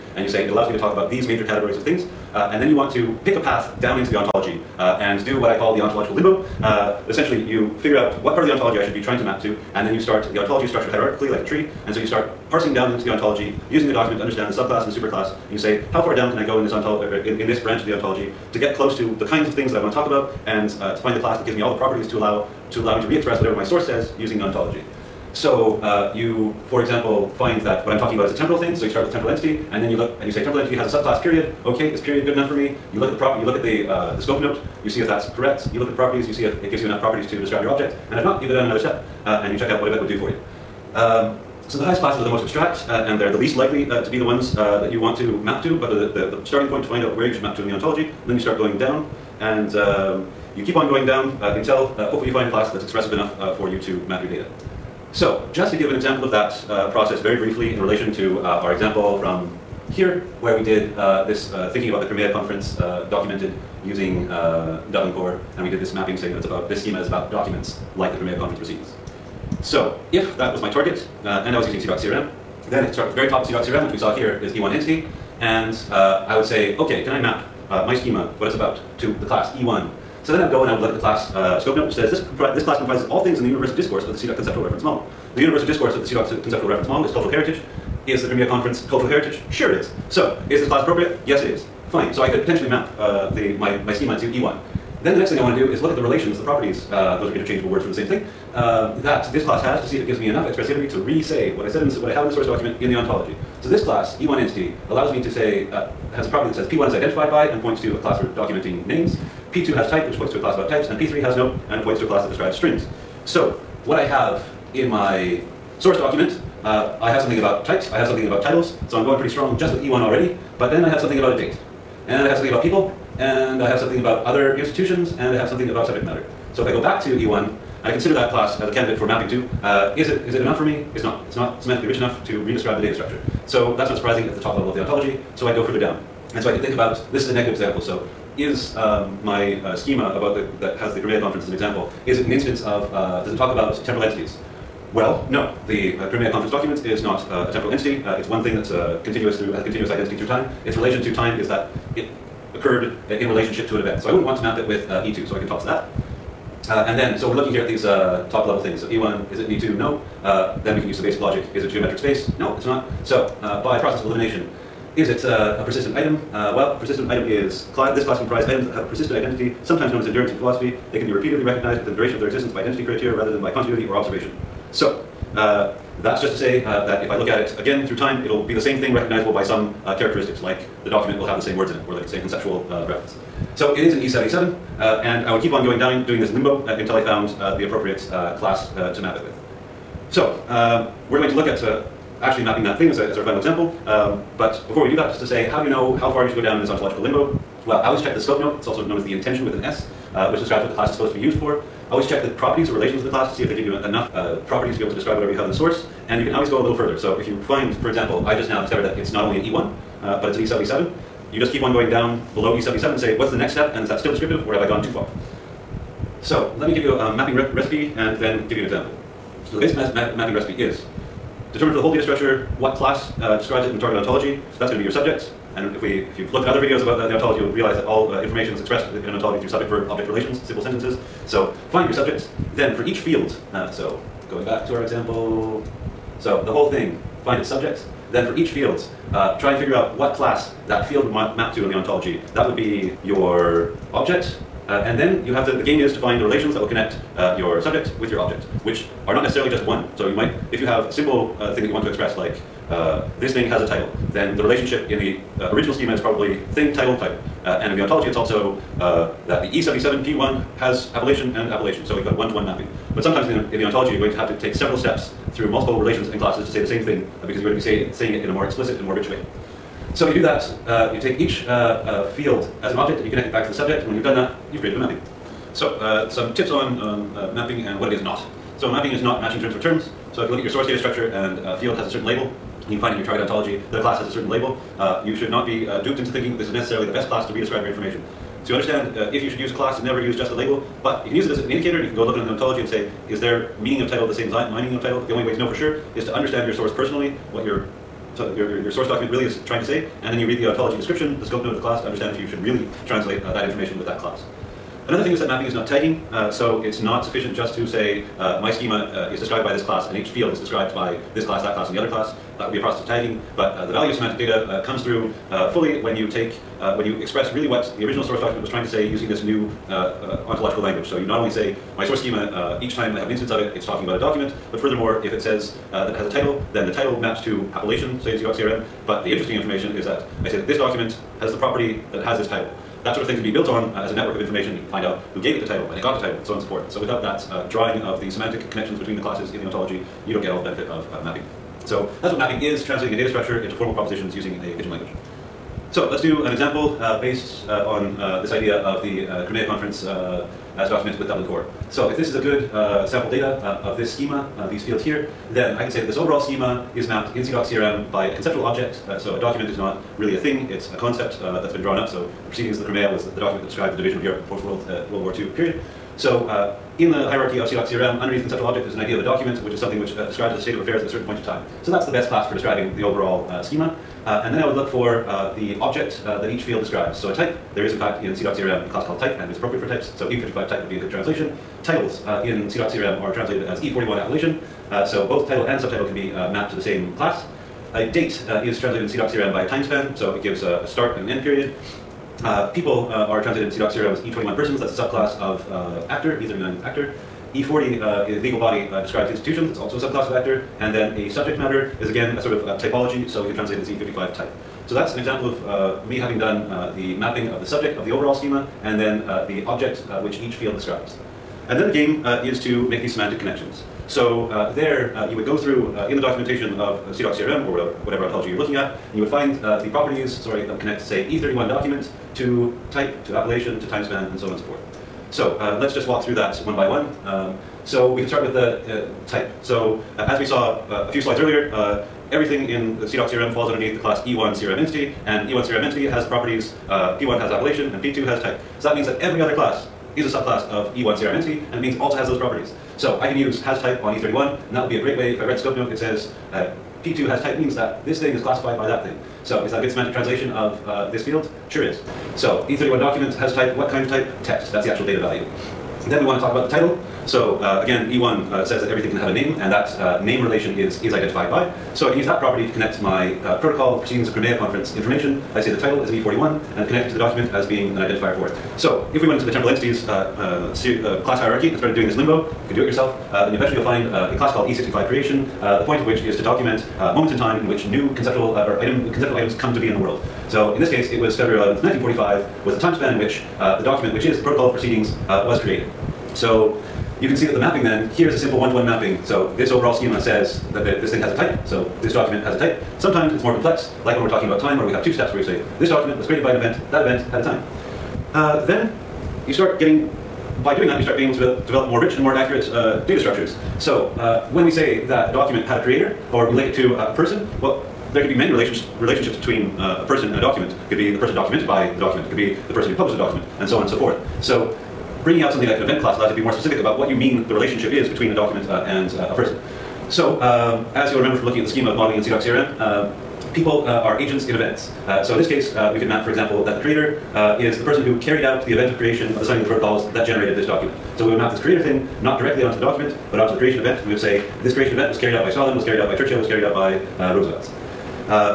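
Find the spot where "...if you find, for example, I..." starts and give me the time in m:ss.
3:27.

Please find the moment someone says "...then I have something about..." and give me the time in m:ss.
2:00.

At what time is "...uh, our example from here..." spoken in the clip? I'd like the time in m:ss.
0:58.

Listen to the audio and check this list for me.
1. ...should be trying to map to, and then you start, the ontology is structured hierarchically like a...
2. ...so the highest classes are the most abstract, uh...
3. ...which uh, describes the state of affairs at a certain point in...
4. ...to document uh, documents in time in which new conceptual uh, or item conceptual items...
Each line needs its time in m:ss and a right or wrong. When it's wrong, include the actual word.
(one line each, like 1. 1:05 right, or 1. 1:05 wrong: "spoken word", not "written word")
1. 0:08 right
2. 0:41 right
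3. 6:09 right
4. 7:56 wrong: "moments", not "documents".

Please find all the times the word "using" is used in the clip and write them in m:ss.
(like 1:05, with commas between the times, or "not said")
0:13, 0:24, 1:03, 1:11, 5:18, 5:44.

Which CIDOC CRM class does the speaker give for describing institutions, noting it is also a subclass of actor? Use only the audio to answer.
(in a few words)
legal body.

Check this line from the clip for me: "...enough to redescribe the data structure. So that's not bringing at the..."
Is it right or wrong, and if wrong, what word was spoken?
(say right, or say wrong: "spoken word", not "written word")
wrong: "surprising", not "bringing".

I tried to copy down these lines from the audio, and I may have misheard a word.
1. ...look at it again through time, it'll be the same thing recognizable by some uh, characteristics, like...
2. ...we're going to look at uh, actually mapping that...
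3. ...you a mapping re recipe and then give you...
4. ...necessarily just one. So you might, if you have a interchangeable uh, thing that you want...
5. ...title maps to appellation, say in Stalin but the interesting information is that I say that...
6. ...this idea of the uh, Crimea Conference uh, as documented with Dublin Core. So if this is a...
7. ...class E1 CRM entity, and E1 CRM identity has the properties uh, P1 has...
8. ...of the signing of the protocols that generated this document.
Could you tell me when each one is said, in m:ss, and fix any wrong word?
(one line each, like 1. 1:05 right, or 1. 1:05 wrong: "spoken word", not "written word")
1. 2:57 right
2. 3:11 right
3. 3:36 right
4. 4:09 wrong: "simple", not "interchangeable"
5. 5:26 wrong: "CIDOC", not "Stalin"
6. 5:48 right
7. 7:13 wrong: "entity", not "identity"
8. 8:49 right.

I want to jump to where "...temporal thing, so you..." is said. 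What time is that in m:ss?
0:28.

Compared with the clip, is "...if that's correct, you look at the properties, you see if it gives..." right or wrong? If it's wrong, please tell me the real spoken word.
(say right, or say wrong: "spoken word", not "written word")
right.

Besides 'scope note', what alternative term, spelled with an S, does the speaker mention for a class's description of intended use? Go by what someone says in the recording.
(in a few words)
intension.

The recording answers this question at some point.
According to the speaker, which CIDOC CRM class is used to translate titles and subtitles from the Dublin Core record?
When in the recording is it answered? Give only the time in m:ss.
6:23.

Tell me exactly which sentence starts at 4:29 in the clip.
So you do that uh, you take each uh, uh, field as an object and you connect it back to the subject.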